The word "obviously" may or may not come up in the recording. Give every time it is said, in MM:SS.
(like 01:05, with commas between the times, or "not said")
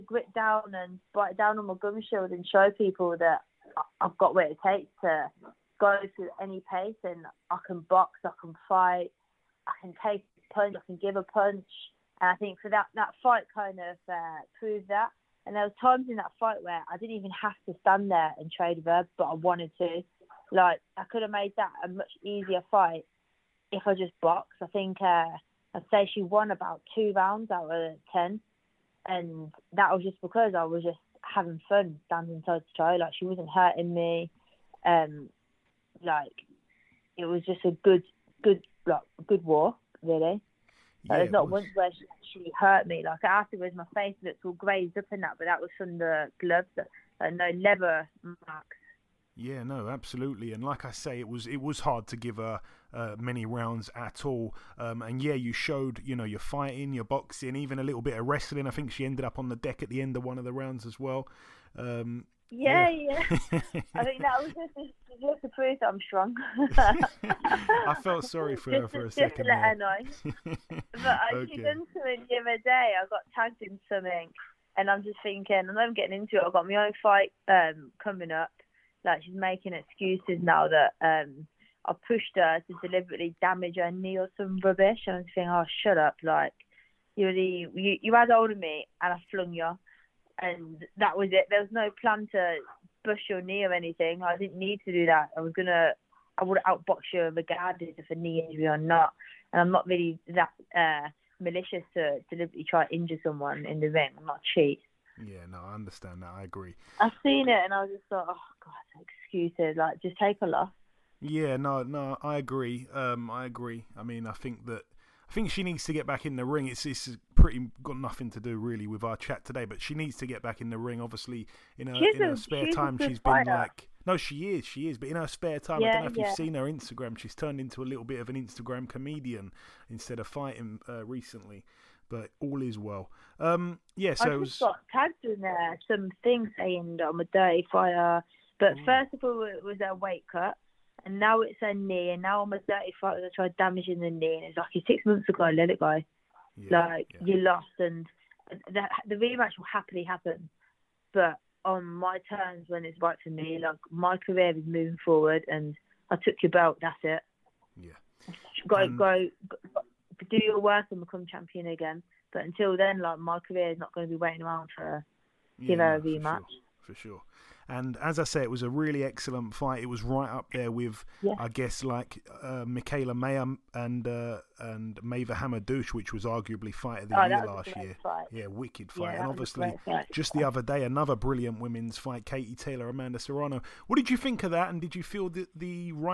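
02:00, 02:59.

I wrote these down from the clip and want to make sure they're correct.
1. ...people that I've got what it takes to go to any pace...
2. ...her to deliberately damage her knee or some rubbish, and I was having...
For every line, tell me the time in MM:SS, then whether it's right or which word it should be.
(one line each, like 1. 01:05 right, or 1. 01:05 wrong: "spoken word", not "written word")
1. 00:02 right
2. 01:22 wrong: "thinking", not "having".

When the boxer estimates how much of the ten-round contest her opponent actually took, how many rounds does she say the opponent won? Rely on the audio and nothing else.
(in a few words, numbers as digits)
2.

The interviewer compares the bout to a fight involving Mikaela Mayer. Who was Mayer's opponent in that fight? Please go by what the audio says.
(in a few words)
Maïva Hamadouche.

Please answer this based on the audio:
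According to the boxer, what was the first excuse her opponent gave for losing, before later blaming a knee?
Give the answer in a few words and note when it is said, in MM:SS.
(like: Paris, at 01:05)
a weight cut, at 02:19.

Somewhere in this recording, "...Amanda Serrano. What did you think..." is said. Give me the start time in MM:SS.
03:02.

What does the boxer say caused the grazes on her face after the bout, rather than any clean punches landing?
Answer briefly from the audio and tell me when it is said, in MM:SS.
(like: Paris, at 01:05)
the gloves, at 00:45.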